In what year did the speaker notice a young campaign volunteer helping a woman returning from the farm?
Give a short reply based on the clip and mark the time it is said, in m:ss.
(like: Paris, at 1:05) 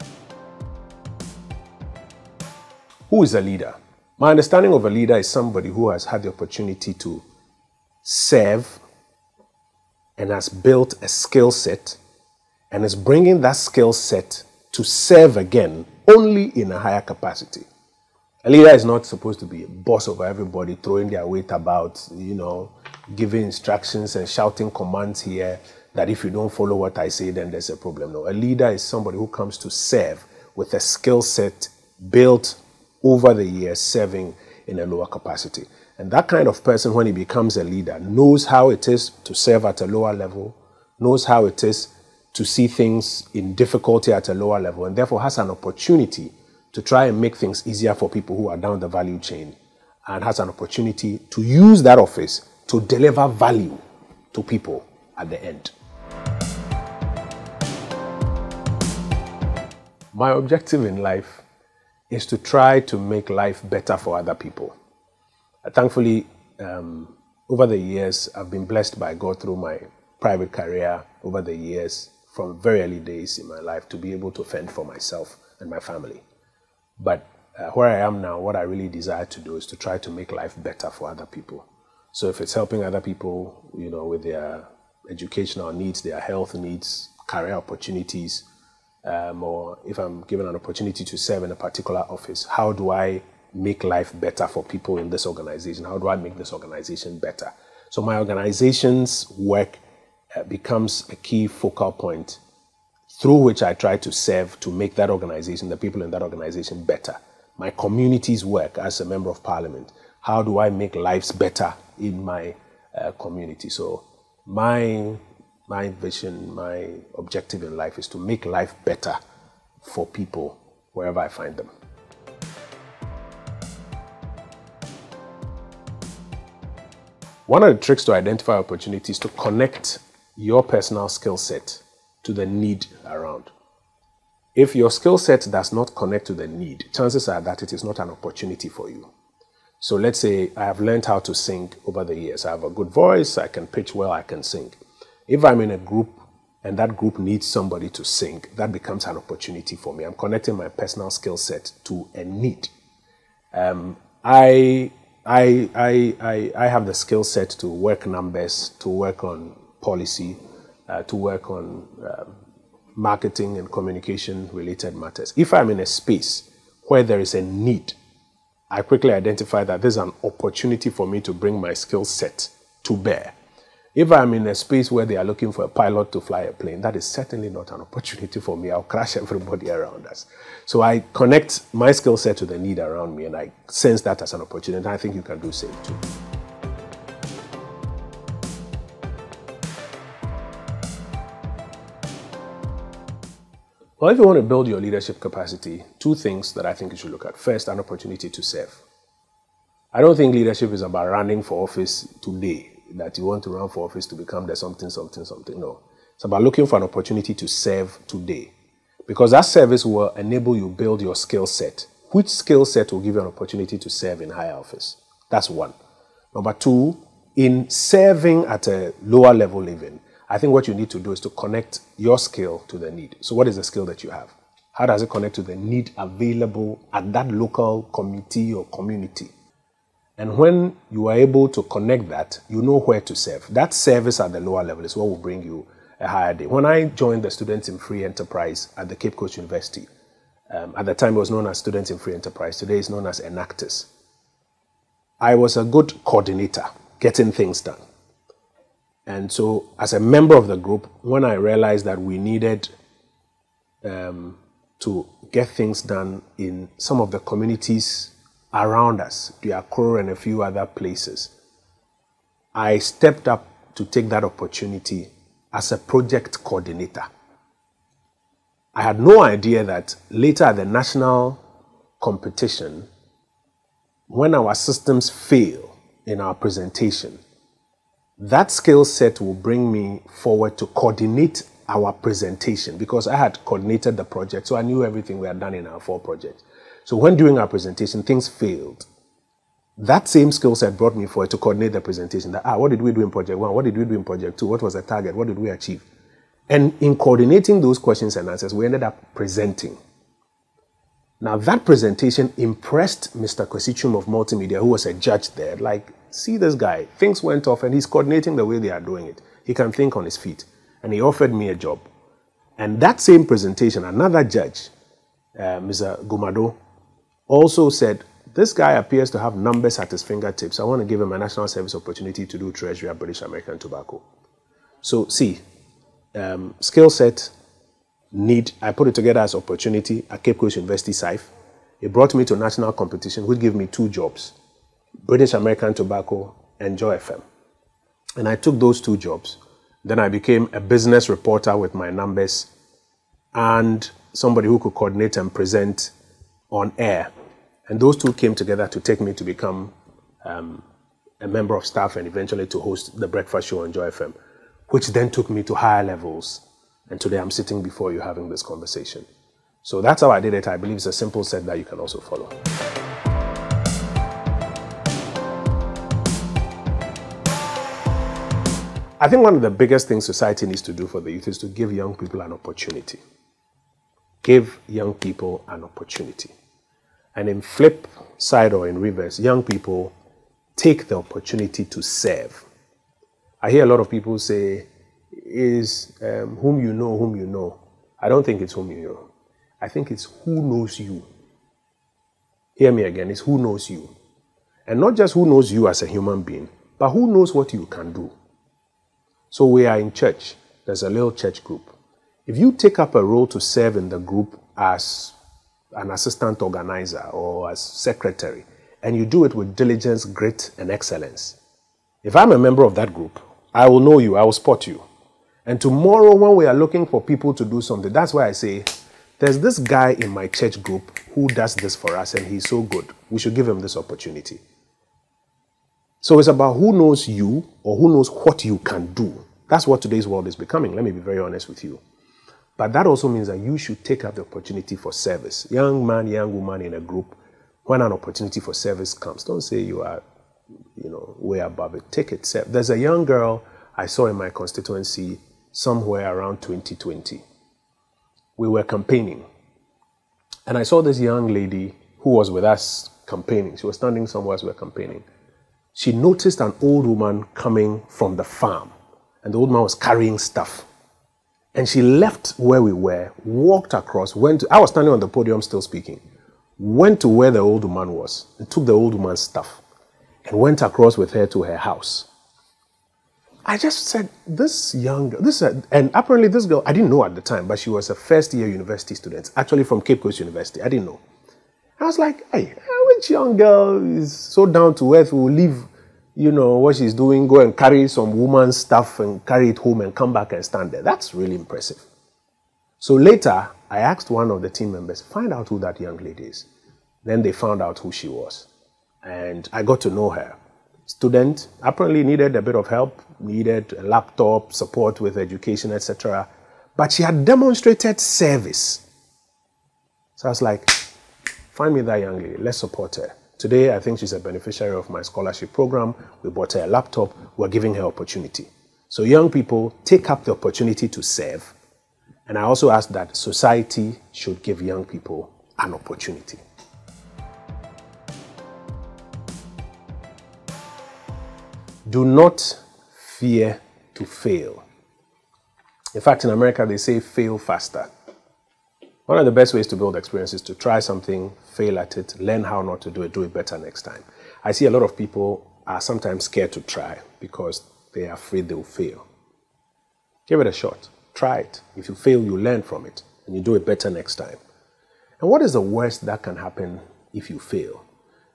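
2020, at 7:26.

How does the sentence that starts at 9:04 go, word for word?
I see a lot of people are sometimes scared to try because they are afraid they will fail.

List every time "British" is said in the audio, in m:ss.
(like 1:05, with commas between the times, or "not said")
5:22, 5:35.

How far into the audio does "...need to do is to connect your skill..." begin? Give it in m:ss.
3:40.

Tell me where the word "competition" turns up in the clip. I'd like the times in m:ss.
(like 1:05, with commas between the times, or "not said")
4:32, 5:32.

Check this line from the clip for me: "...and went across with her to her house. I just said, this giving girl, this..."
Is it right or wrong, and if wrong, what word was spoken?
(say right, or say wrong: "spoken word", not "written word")
wrong: "young", not "giving".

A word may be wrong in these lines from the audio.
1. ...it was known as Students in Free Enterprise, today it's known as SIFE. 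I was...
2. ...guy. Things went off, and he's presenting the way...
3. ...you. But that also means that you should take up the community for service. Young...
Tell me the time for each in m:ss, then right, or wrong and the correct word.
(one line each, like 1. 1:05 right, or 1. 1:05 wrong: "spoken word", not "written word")
1. 4:01 wrong: "Enactus", not "SIFE"
2. 5:06 wrong: "coordinating", not "presenting"
3. 7:11 wrong: "opportunity", not "community".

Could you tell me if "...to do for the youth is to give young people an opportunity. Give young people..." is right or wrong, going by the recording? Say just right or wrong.
right.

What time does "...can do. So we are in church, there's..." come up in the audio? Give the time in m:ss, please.
6:37.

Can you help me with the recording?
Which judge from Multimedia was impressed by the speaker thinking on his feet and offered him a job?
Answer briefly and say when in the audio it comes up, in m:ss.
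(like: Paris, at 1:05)
Kwesi Twum, at 5:03.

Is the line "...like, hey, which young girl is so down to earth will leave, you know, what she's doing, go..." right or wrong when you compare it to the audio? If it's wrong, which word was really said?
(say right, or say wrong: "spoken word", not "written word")
right.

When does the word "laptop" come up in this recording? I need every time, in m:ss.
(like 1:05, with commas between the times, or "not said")
8:23, 8:36.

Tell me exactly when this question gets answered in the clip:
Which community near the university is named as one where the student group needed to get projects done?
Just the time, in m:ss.
4:19.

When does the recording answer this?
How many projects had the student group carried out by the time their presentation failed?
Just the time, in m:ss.
4:45.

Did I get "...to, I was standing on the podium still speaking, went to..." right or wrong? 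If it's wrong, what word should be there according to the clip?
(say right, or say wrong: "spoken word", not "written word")
right.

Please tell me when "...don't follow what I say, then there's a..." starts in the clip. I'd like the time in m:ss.
0:26.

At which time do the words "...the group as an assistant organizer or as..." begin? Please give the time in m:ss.
6:43.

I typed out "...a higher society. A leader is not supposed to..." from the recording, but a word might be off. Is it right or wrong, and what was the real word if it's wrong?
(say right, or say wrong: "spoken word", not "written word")
wrong: "capacity", not "society".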